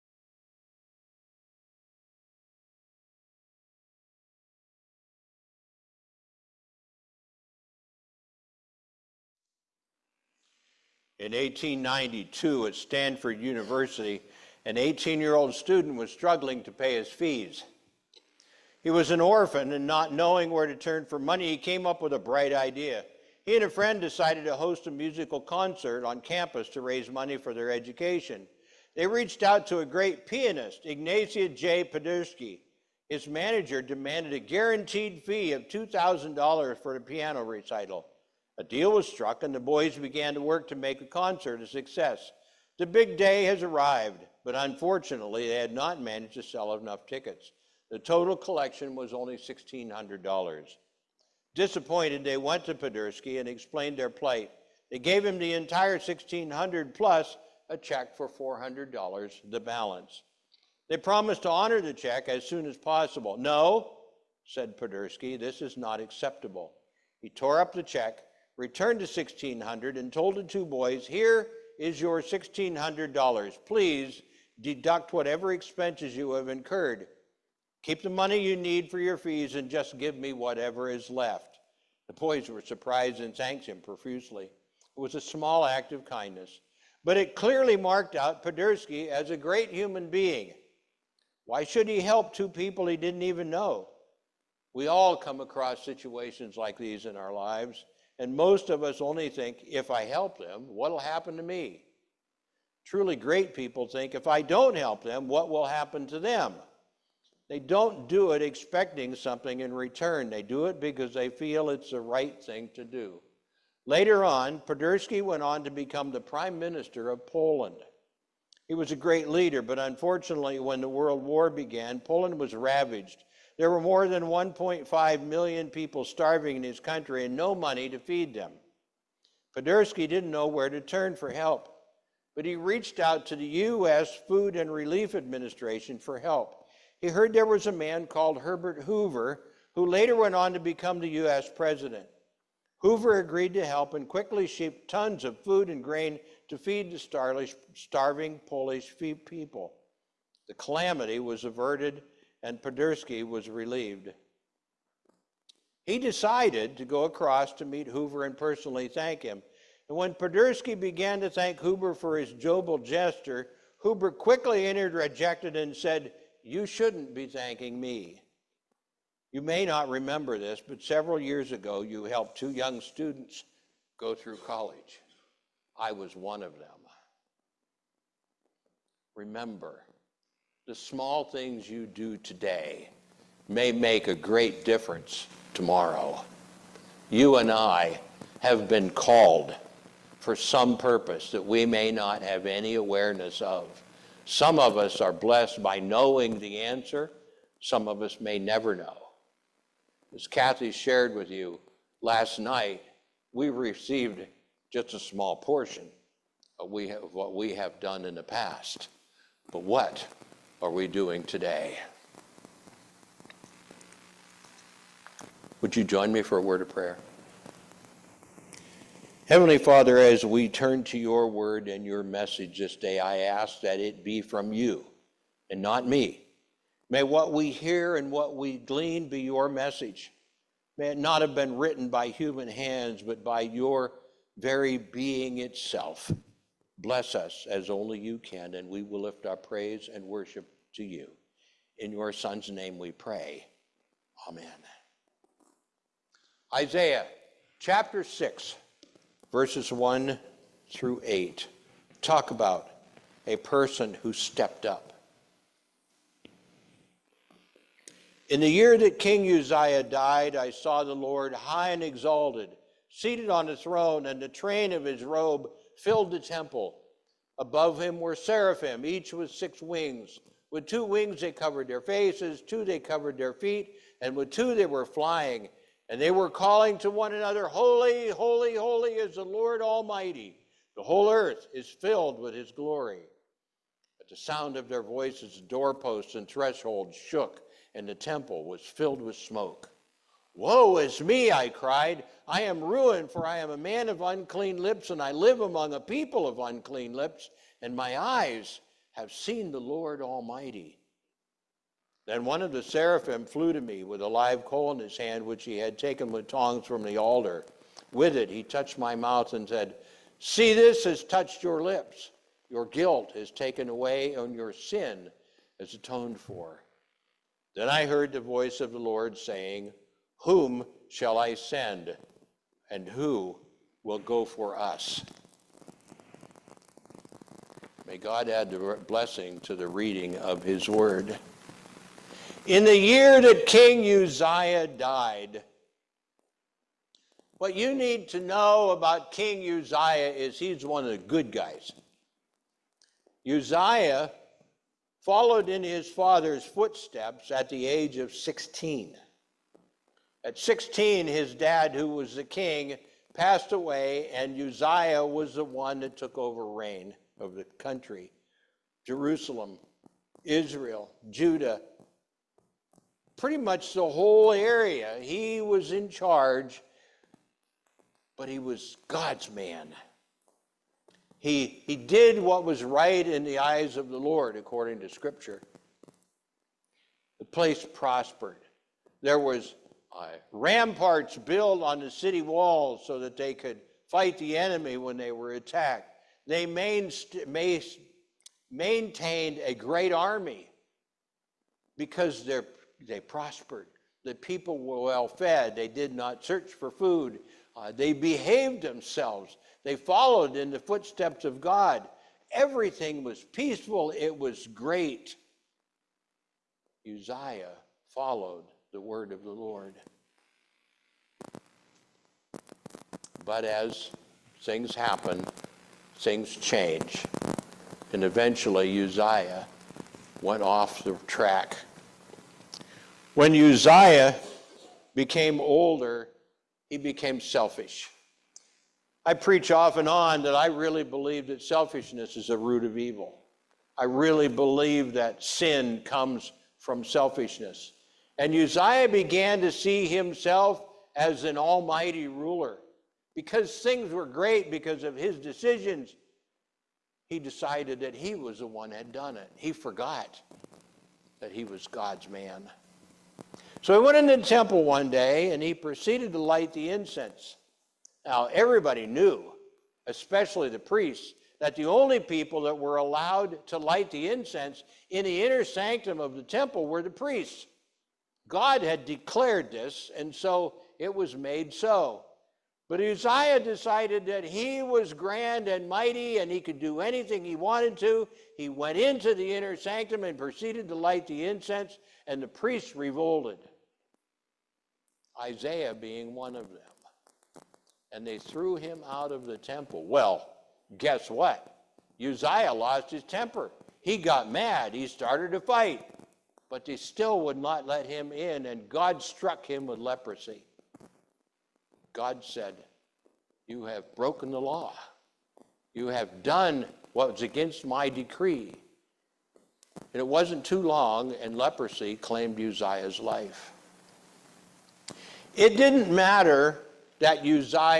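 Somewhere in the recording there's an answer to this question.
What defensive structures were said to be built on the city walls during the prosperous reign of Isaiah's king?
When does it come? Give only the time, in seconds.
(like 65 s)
380 s.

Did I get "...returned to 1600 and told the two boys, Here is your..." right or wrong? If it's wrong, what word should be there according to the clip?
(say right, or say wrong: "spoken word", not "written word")
right.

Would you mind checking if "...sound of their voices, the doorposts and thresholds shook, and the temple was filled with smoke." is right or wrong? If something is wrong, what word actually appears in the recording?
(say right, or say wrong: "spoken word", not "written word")
right.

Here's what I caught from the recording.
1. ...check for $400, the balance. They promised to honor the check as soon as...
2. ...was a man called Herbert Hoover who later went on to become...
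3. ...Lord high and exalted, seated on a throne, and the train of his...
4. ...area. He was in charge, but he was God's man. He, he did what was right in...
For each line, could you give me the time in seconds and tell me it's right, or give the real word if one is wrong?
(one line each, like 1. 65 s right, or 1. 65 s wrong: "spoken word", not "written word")
1. 57 s right
2. 137 s right
3. 260 s right
4. 364 s right.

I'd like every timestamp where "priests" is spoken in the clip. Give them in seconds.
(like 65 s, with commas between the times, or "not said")
460 s, 466 s, 482 s.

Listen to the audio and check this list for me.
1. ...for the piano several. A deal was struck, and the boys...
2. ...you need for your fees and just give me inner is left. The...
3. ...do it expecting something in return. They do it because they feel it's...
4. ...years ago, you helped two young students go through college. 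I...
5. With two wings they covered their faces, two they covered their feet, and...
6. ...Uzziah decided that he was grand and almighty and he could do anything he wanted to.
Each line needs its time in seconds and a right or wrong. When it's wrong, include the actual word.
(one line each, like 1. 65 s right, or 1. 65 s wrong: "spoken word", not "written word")
1. 36 s wrong: "recital", not "several"
2. 78 s wrong: "whatever", not "inner"
3. 108 s right
4. 171 s right
5. 270 s right
6. 472 s wrong: "mighty", not "almighty".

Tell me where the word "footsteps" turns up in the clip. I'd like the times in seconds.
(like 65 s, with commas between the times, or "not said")
346 s, 400 s.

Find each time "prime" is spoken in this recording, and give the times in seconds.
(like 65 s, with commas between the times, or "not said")
116 s.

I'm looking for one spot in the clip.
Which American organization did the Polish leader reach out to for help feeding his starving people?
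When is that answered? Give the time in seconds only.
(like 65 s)
133 s.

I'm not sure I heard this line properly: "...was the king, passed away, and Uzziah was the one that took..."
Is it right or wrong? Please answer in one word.
right.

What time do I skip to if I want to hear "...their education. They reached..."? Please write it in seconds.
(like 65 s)
27 s.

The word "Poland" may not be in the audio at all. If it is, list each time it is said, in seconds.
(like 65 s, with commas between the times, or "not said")
117 s, 121 s.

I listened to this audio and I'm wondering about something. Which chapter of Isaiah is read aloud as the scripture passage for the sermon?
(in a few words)
Chapter 6.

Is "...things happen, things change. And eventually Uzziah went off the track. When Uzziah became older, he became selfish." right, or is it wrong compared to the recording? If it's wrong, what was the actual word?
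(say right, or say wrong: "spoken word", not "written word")
right.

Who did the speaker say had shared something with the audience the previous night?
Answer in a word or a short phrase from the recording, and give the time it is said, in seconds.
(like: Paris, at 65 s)
Kathy, at 200 s.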